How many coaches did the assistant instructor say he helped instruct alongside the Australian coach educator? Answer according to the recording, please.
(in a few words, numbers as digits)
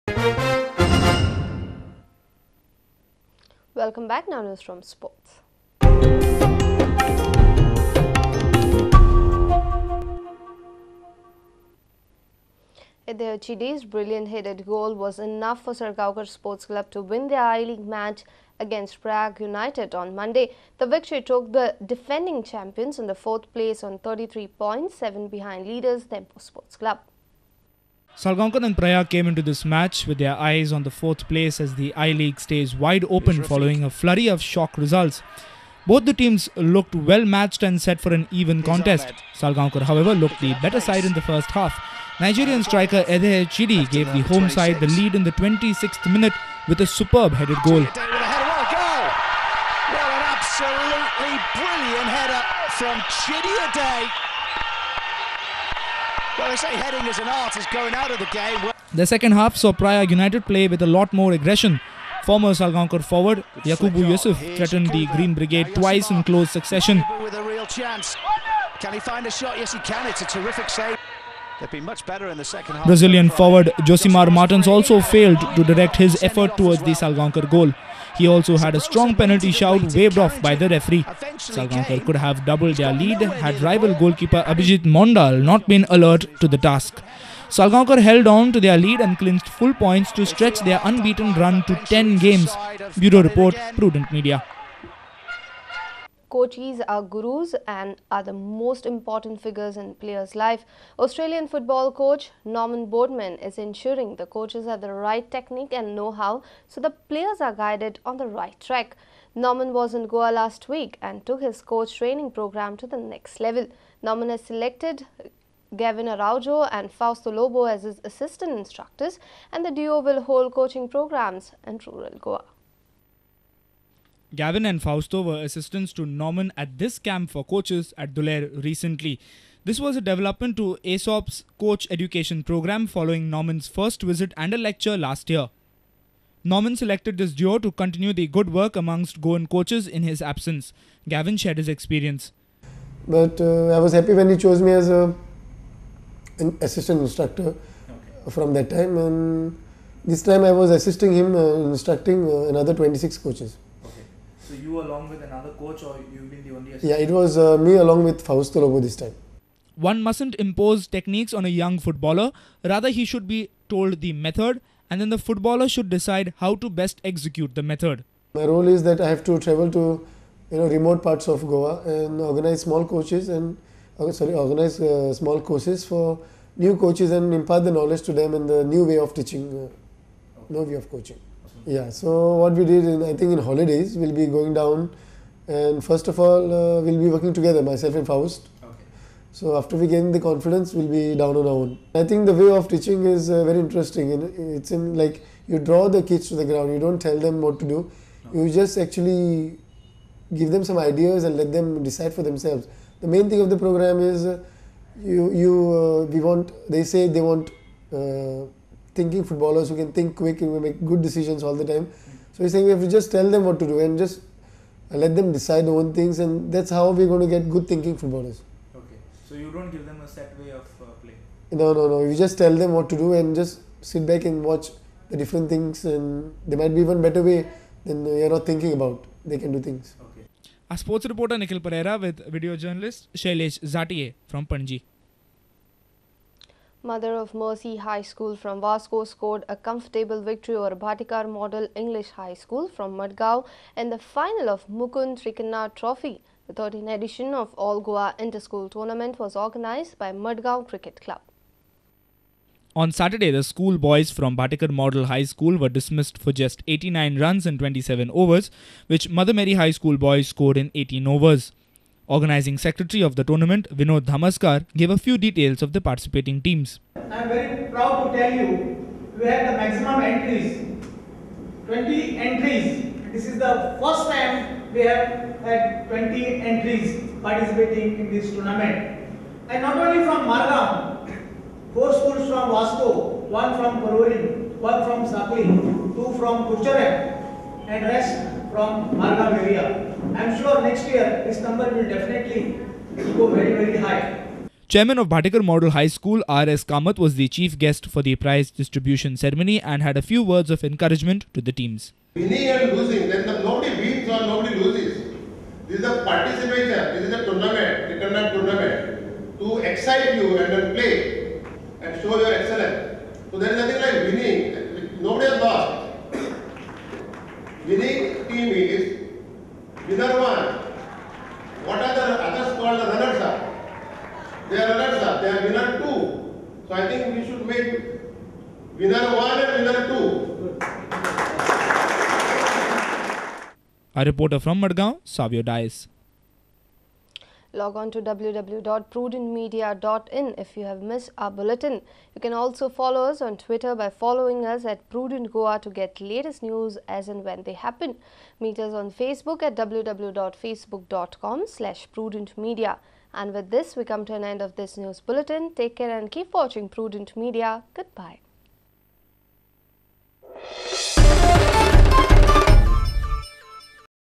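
26.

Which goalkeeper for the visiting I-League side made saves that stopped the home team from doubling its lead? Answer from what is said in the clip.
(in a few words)
Abhijit Mondal.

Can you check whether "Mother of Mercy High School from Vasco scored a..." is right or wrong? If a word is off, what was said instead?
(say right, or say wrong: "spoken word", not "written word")
right.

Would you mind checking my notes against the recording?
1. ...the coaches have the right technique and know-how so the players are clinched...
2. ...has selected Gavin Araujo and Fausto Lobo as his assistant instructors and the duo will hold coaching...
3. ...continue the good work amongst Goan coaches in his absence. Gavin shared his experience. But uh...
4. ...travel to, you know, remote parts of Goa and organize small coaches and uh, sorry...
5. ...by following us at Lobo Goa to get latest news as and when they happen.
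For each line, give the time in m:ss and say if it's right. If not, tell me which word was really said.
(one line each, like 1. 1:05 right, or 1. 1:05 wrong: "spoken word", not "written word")
1. 1:44 wrong: "guided", not "clinched"
2. 1:54 right
3. 2:17 right
4. 2:49 right
5. 5:43 wrong: "Prudent", not "Lobo".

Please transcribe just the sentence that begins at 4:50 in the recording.
I am sure next year this number will definitely go very, very high.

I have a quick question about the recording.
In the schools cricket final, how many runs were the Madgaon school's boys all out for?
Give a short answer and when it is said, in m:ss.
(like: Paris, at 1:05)
89, at 4:16.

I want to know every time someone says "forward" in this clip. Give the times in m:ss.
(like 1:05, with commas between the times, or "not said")
1:03, 1:13.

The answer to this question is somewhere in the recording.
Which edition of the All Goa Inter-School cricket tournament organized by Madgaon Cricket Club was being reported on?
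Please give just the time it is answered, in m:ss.
4:06.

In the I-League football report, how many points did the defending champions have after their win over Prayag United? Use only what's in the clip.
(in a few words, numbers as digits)
33.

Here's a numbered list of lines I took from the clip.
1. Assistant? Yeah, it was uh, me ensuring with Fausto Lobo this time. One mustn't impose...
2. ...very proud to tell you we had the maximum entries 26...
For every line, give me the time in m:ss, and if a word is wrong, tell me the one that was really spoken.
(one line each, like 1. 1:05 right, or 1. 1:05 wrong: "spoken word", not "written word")
1. 2:36 wrong: "along", not "ensuring"
2. 4:27 wrong: "20", not "26".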